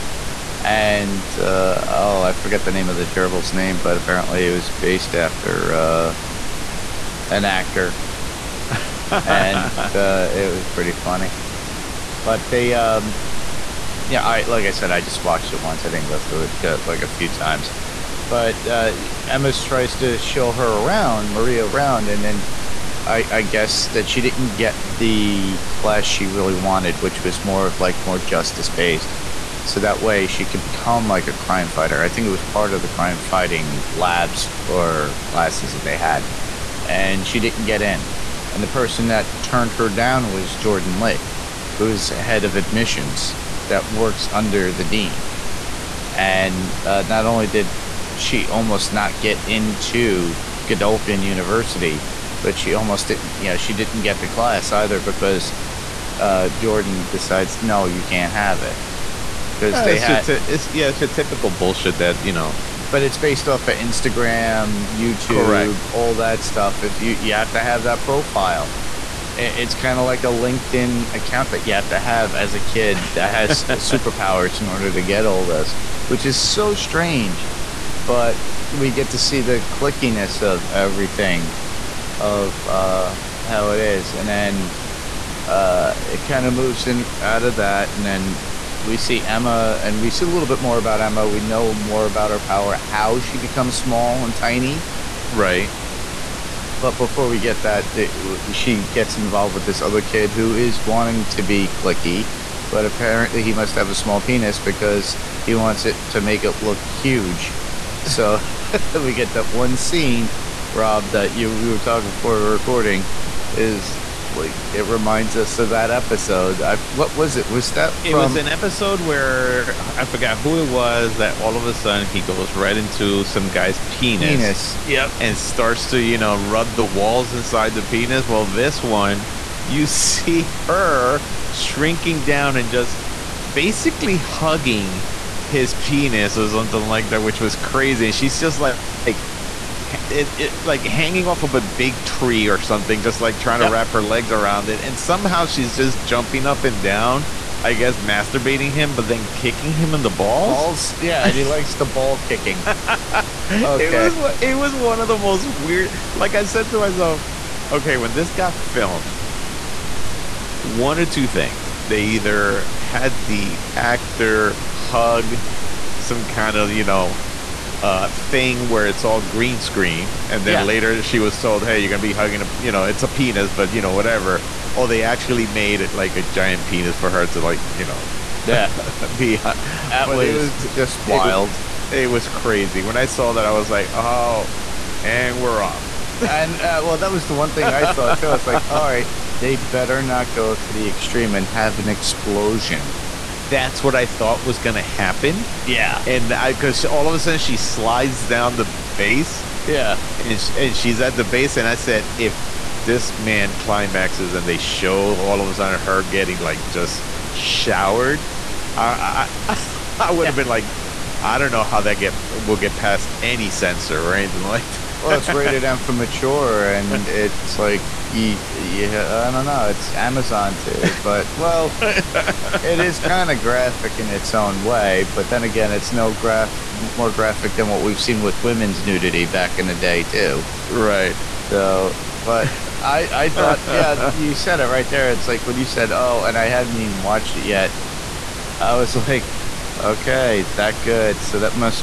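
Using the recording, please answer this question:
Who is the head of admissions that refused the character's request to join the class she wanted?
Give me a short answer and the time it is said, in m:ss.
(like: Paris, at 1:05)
Jordan Li, at 0:40.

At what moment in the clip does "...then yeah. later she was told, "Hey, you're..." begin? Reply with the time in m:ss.
2:50.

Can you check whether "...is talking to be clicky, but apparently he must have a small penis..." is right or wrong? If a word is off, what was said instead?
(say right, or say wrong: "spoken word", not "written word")
wrong: "wanting", not "talking".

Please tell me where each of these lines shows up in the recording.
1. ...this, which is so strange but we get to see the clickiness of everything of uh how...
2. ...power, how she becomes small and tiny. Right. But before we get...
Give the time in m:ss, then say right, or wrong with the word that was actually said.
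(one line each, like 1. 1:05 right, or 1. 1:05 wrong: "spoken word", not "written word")
1. 1:15 right
2. 1:32 right.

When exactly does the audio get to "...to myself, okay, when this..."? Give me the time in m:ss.
2:36.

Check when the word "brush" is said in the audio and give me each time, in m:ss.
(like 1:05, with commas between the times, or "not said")
not said.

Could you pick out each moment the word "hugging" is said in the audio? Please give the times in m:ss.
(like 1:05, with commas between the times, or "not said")
2:14, 2:52.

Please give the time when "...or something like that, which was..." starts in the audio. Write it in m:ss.
2:16.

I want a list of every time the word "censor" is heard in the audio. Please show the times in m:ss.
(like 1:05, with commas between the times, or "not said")
3:33.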